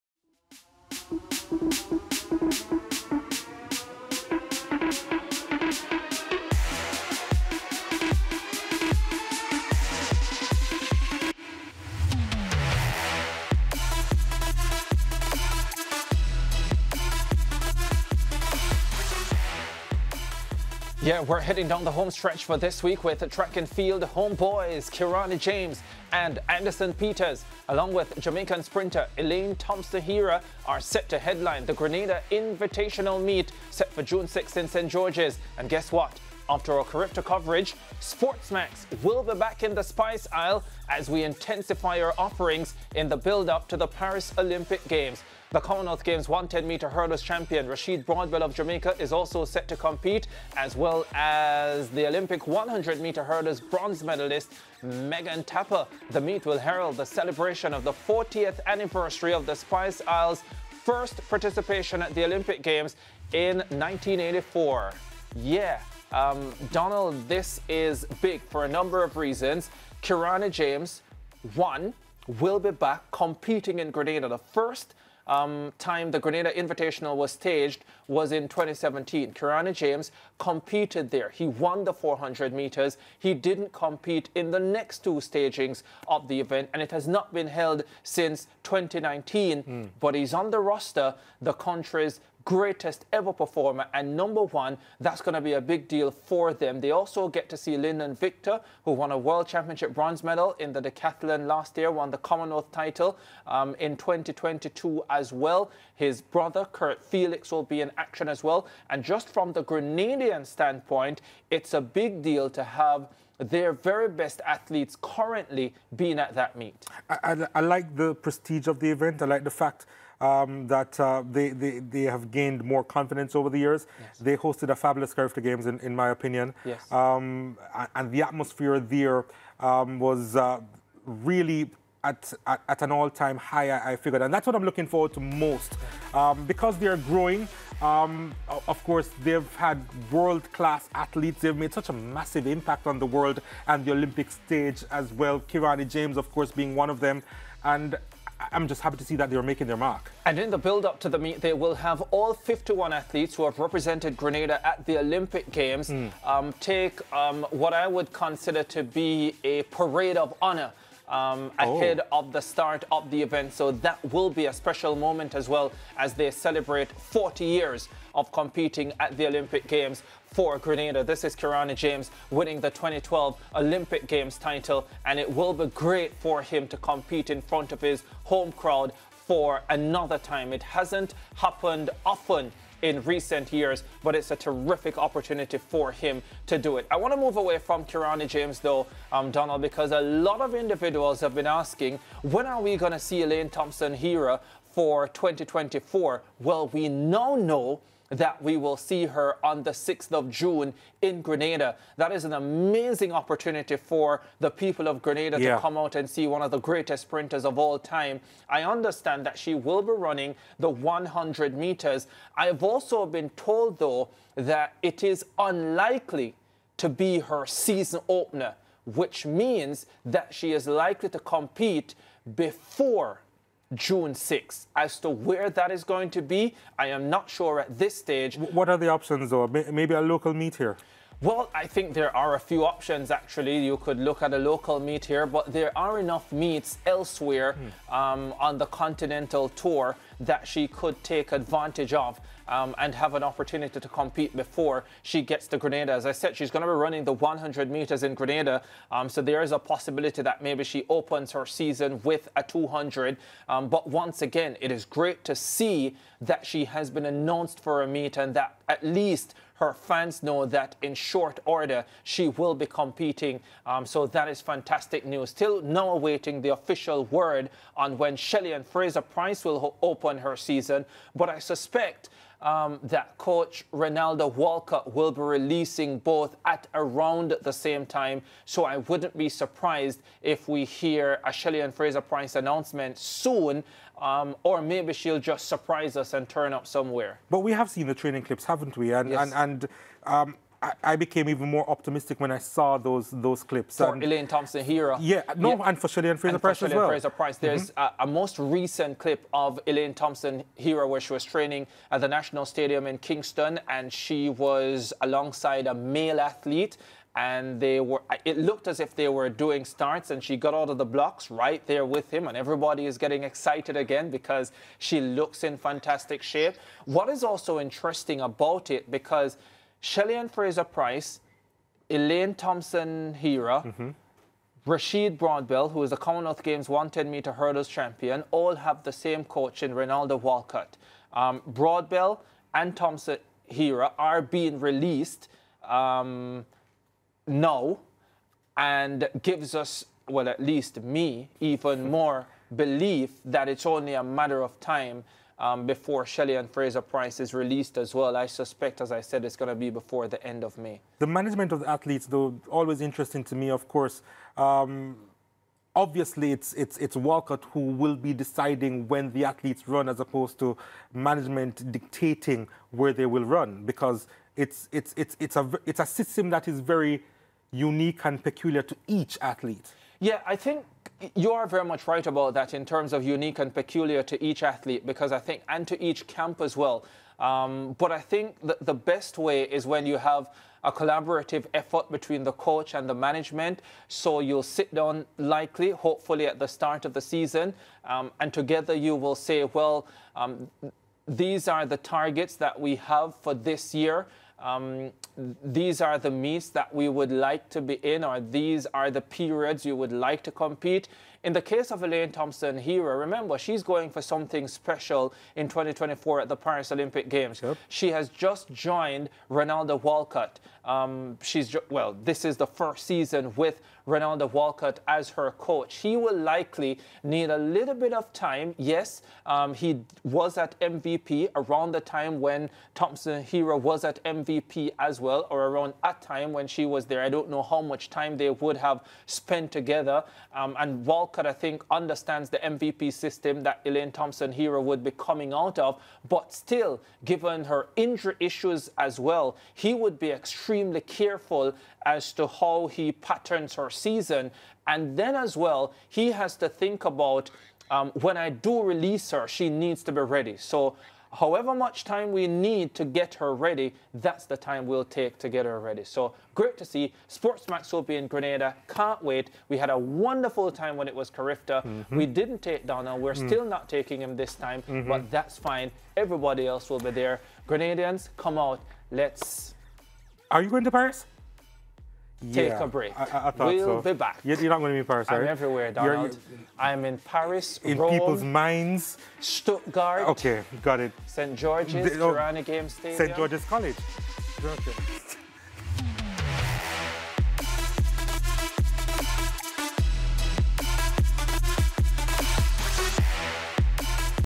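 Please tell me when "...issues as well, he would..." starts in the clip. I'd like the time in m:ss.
7:18.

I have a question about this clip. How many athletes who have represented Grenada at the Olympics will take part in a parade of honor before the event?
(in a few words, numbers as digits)
51.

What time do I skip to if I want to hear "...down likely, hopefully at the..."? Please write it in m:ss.
6:24.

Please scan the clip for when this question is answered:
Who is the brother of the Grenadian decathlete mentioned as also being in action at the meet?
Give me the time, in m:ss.
1:46.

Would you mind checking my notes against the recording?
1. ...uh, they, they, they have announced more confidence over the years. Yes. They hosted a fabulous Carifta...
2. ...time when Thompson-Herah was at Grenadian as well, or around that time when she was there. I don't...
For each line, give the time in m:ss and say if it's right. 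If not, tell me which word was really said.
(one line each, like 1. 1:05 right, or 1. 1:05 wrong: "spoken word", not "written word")
1. 2:00 wrong: "gained", not "announced"
2. 7:01 wrong: "MVP", not "Grenadian".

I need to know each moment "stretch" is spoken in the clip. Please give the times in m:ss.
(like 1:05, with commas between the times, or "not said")
0:22.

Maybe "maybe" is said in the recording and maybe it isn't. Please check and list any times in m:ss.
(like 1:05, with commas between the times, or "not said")
3:49, 4:10, 4:44.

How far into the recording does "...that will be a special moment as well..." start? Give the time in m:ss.
2:43.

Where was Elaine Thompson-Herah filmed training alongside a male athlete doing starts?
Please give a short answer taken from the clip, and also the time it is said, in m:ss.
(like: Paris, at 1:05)
National Stadium in Kingston, at 5:02.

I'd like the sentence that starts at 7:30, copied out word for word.
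So however much time we need to get her ready, that's the time we'll take to get her ready.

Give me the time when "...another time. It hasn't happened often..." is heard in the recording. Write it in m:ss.
2:59.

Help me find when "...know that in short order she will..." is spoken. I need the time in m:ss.
4:20.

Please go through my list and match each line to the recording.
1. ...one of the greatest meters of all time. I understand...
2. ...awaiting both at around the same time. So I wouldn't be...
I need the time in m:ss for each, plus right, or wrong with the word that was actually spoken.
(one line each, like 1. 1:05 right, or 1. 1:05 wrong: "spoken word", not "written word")
1. 3:26 wrong: "sprinters", not "meters"
2. 4:35 wrong: "releasing", not "awaiting".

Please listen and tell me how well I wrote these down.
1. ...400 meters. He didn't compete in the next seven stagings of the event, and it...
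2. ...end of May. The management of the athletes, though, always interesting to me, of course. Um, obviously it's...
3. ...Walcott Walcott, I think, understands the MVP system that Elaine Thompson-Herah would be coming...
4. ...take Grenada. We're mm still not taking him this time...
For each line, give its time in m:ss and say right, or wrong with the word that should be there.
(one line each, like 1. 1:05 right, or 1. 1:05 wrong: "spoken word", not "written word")
1. 1:21 wrong: "two", not "seven"
2. 5:50 right
3. 7:10 right
4. 7:42 wrong: "Donald", not "Grenada".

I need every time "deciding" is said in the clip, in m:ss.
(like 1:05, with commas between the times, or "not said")
5:58.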